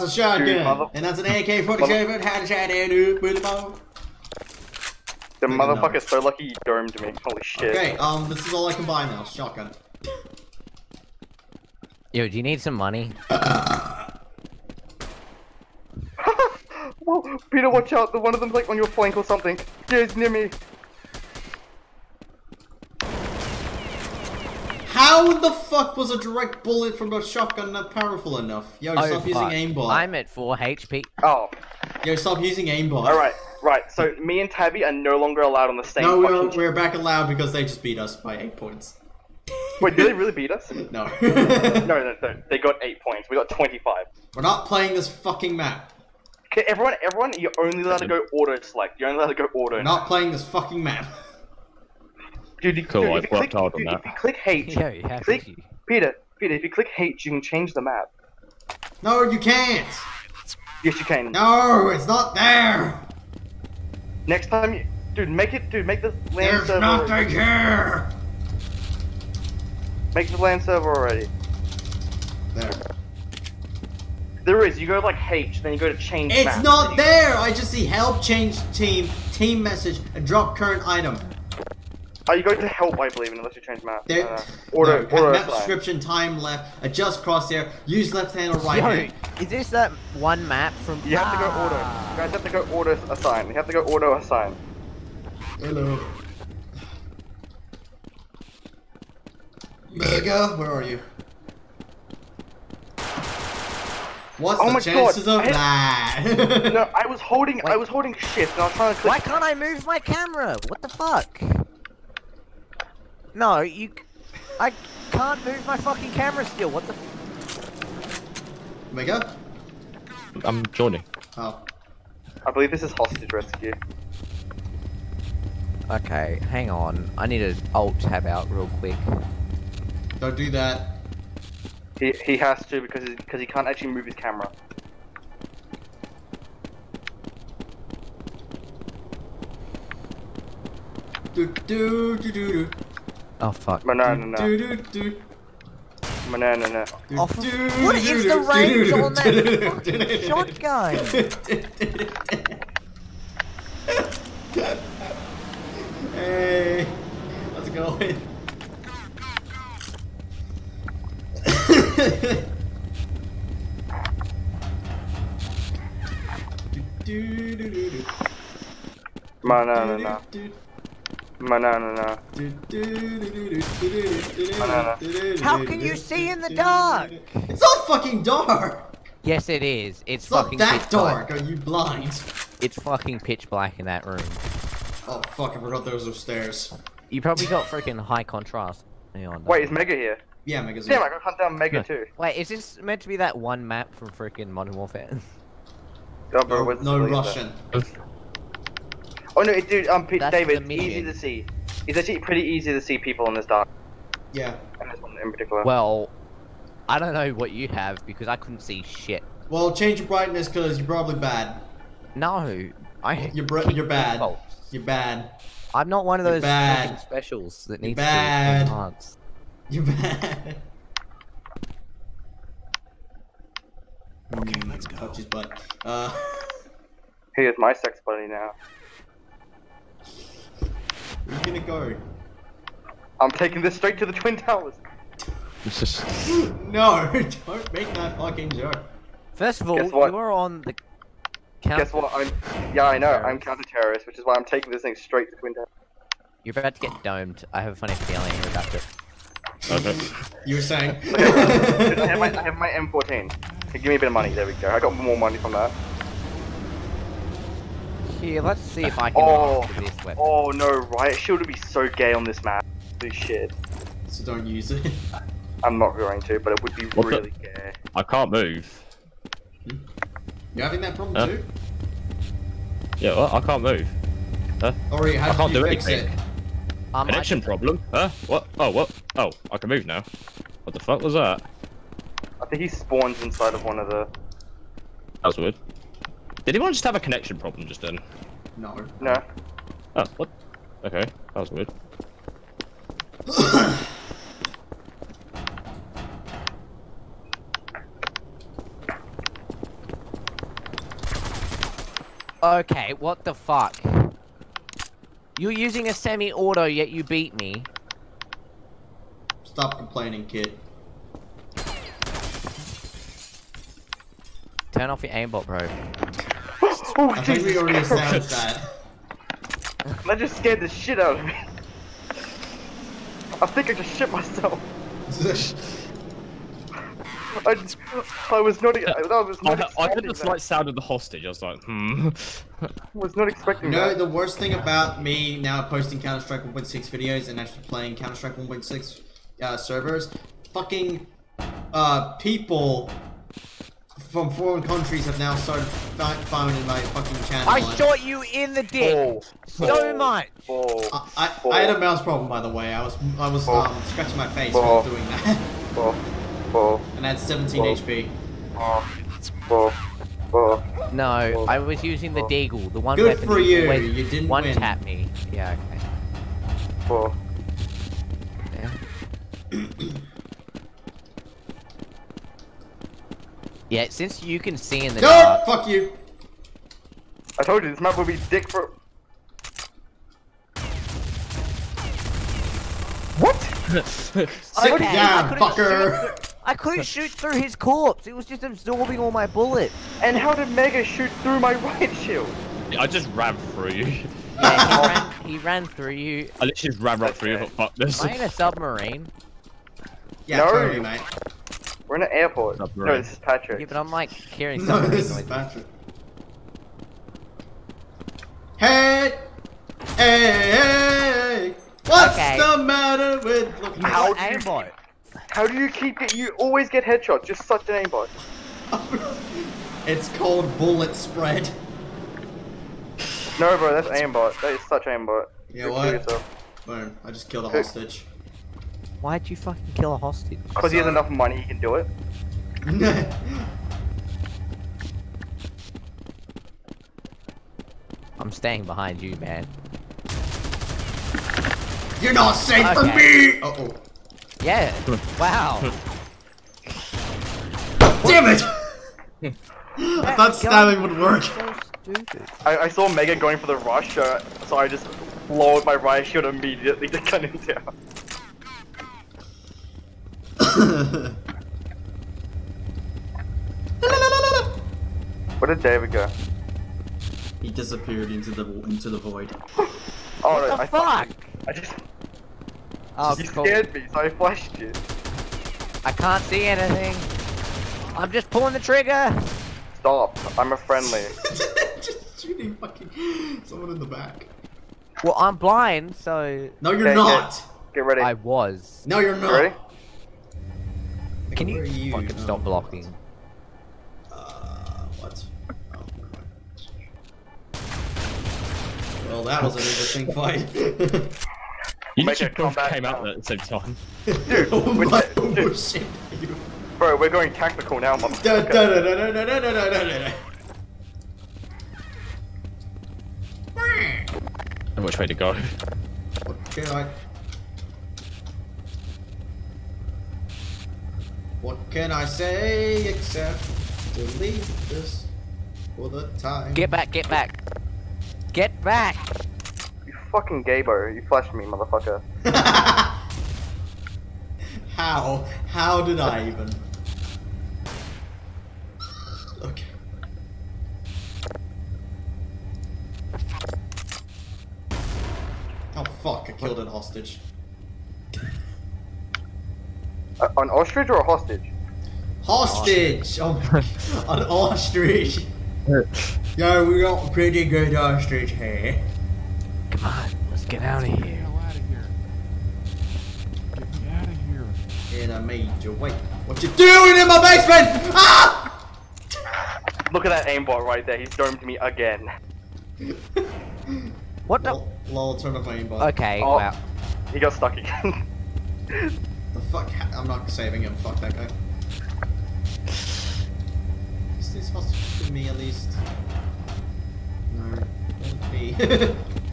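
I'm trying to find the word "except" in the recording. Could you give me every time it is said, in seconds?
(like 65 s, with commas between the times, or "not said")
522 s.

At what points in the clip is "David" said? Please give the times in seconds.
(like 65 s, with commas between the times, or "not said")
200 s, 465 s.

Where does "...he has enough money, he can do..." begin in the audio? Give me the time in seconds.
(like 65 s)
430 s.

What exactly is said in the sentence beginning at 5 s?
The motherfucker's so lucky you domed me.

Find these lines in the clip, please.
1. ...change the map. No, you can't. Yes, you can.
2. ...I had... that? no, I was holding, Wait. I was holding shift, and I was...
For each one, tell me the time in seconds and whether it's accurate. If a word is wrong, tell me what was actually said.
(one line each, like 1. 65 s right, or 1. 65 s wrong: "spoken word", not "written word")
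1. 57 s right
2. 105 s right.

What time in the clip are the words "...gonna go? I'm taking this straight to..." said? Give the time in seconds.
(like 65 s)
231 s.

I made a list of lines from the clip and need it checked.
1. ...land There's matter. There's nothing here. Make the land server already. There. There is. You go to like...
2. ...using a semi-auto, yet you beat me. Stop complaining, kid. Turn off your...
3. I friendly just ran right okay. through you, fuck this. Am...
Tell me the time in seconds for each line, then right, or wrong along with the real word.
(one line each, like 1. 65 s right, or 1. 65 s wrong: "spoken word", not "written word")
1. 66 s wrong: "server", not "matter"
2. 305 s right
3. 396 s wrong: "literally", not "friendly".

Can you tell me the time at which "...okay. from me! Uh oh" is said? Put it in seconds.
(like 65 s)
442 s.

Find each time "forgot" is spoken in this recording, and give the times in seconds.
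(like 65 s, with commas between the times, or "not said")
185 s.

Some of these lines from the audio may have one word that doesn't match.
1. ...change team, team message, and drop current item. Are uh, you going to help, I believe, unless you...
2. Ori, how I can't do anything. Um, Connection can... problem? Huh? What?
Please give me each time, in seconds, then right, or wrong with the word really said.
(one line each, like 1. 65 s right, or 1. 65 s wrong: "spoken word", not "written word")
1. 78 s right
2. 274 s right.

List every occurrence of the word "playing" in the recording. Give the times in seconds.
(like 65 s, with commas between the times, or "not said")
44 s, 50 s, 337 s.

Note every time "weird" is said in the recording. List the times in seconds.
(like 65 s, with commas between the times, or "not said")
285 s, 291 s.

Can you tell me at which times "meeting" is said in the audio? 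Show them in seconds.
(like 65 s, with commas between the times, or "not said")
not said.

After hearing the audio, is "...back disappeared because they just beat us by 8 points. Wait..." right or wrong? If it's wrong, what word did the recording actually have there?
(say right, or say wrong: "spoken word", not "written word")
wrong: "allowed", not "disappeared".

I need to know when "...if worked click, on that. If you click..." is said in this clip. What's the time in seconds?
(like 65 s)
53 s.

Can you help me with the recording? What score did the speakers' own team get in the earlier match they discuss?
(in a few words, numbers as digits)
25.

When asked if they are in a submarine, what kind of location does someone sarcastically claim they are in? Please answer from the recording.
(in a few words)
Airport.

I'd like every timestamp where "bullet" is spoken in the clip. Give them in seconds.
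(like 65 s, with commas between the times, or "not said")
26 s, 389 s, 420 s.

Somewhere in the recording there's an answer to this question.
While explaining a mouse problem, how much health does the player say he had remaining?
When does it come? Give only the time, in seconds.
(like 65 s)
357 s.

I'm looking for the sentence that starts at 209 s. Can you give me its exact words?
Well, change your brightness because you're probably bad.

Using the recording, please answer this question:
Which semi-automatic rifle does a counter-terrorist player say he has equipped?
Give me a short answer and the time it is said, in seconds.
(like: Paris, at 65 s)
M14, at 252 s.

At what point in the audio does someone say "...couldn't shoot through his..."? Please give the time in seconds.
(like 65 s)
386 s.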